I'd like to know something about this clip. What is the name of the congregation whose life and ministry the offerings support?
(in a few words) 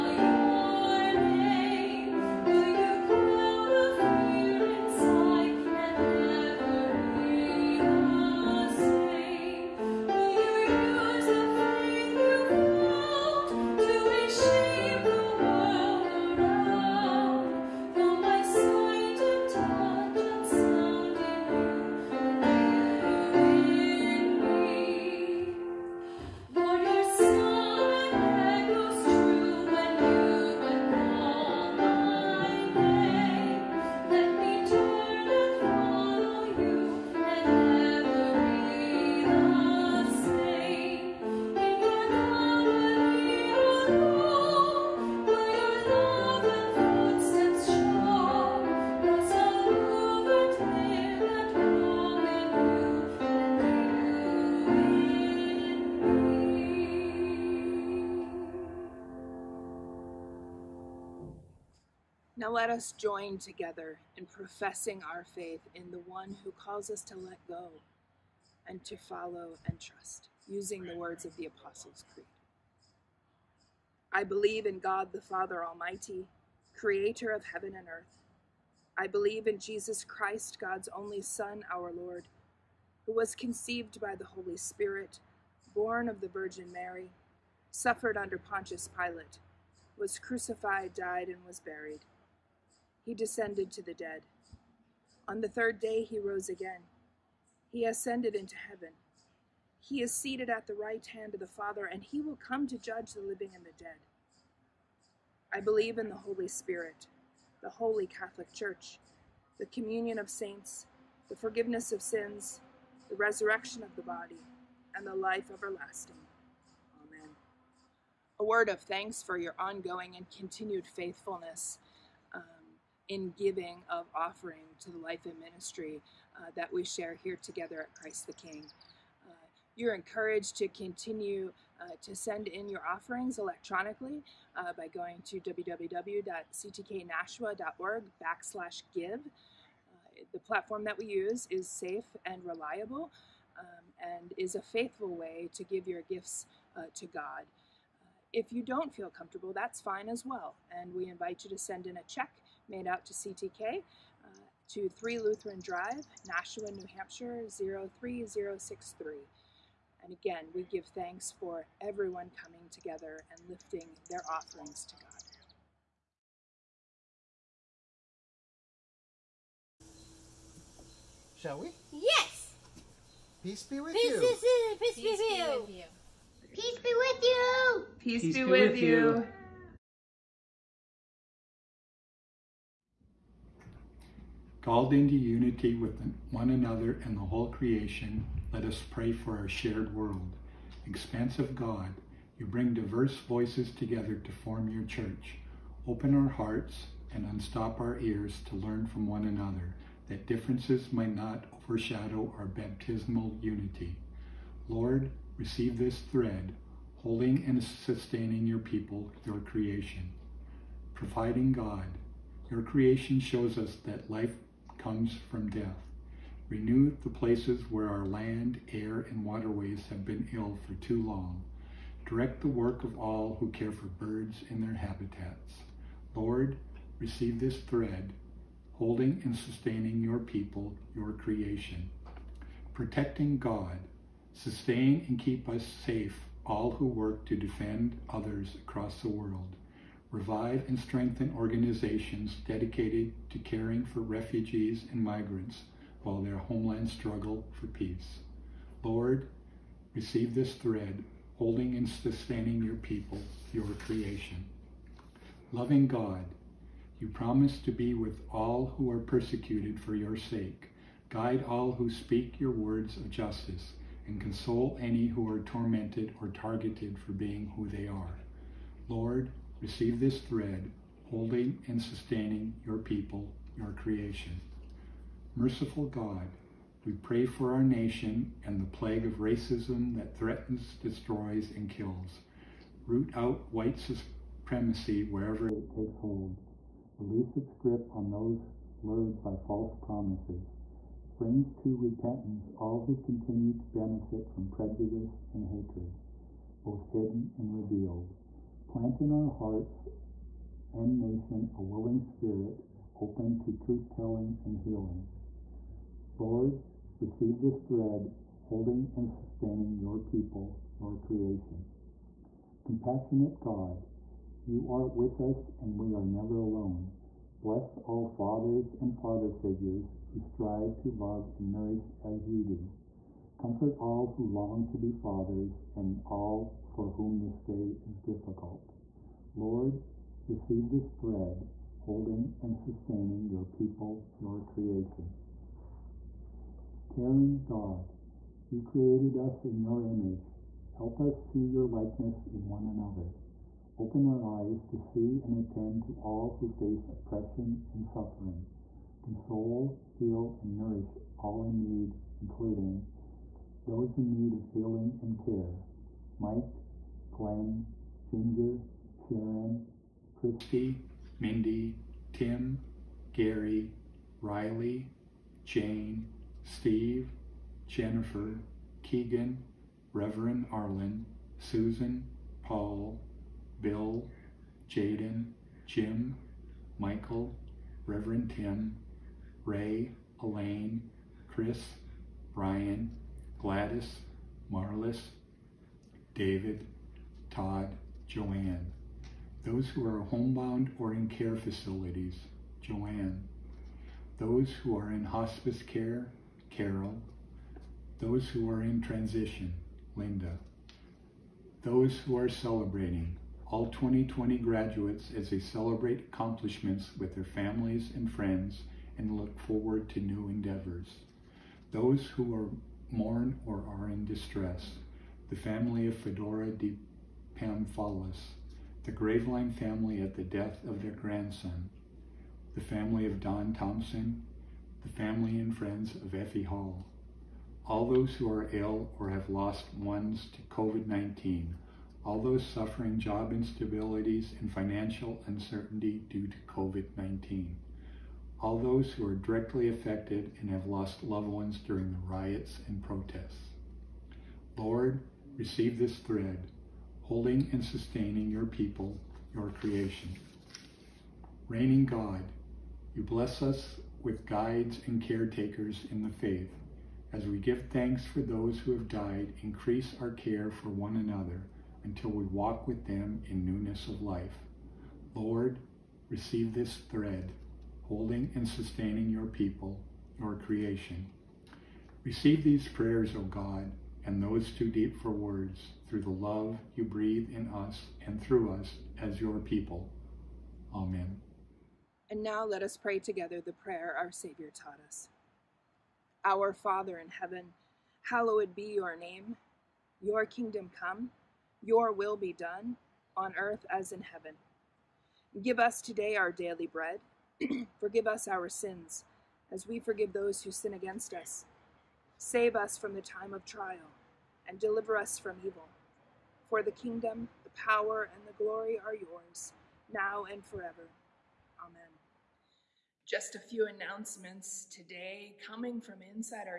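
Christ the King.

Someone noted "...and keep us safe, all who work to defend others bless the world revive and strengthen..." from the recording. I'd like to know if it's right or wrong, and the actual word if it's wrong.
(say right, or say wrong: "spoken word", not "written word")
wrong: "across", not "bless".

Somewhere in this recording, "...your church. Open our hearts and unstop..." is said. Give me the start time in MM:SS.
03:14.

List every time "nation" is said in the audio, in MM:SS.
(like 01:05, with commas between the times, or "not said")
04:37, 05:01.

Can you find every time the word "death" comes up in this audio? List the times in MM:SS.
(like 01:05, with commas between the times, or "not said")
03:35, 07:00.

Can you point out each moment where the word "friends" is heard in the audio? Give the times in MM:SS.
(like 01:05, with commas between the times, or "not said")
06:48, 07:05.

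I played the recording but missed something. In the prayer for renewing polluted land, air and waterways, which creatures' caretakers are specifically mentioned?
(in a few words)
birds.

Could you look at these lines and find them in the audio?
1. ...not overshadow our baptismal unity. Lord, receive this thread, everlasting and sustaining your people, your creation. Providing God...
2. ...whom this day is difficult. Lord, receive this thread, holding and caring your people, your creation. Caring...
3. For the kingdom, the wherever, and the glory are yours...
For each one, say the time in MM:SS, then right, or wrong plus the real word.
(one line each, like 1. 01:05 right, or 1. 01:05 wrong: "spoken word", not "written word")
1. 03:21 wrong: "holding", not "everlasting"
2. 05:26 wrong: "sustaining", not "caring"
3. 08:26 wrong: "power", not "wherever".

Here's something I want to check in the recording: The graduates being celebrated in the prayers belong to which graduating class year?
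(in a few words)
2020.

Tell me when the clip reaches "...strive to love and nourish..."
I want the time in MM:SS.
05:20.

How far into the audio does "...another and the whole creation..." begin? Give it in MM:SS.
03:06.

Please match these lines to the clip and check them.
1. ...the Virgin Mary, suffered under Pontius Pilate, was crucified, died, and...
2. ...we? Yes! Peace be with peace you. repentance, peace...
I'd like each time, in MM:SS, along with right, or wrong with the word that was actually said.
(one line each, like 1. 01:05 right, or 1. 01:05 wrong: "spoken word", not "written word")
1. 01:26 right
2. 02:51 wrong: "peace", not "repentance".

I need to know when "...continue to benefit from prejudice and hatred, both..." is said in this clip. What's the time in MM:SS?
04:52.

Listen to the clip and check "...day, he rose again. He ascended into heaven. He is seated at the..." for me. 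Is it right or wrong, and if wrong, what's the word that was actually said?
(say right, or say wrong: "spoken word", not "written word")
right.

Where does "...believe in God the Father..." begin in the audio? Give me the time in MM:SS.
01:14.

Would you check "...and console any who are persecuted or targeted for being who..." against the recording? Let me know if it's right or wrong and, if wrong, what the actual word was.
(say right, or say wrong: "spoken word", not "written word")
wrong: "tormented", not "persecuted".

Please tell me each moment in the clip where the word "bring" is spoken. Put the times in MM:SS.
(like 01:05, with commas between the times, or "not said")
03:12, 04:51.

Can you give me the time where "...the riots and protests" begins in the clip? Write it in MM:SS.
07:21.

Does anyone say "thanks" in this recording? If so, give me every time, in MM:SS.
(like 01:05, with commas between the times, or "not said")
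01:58, 02:40, 07:37.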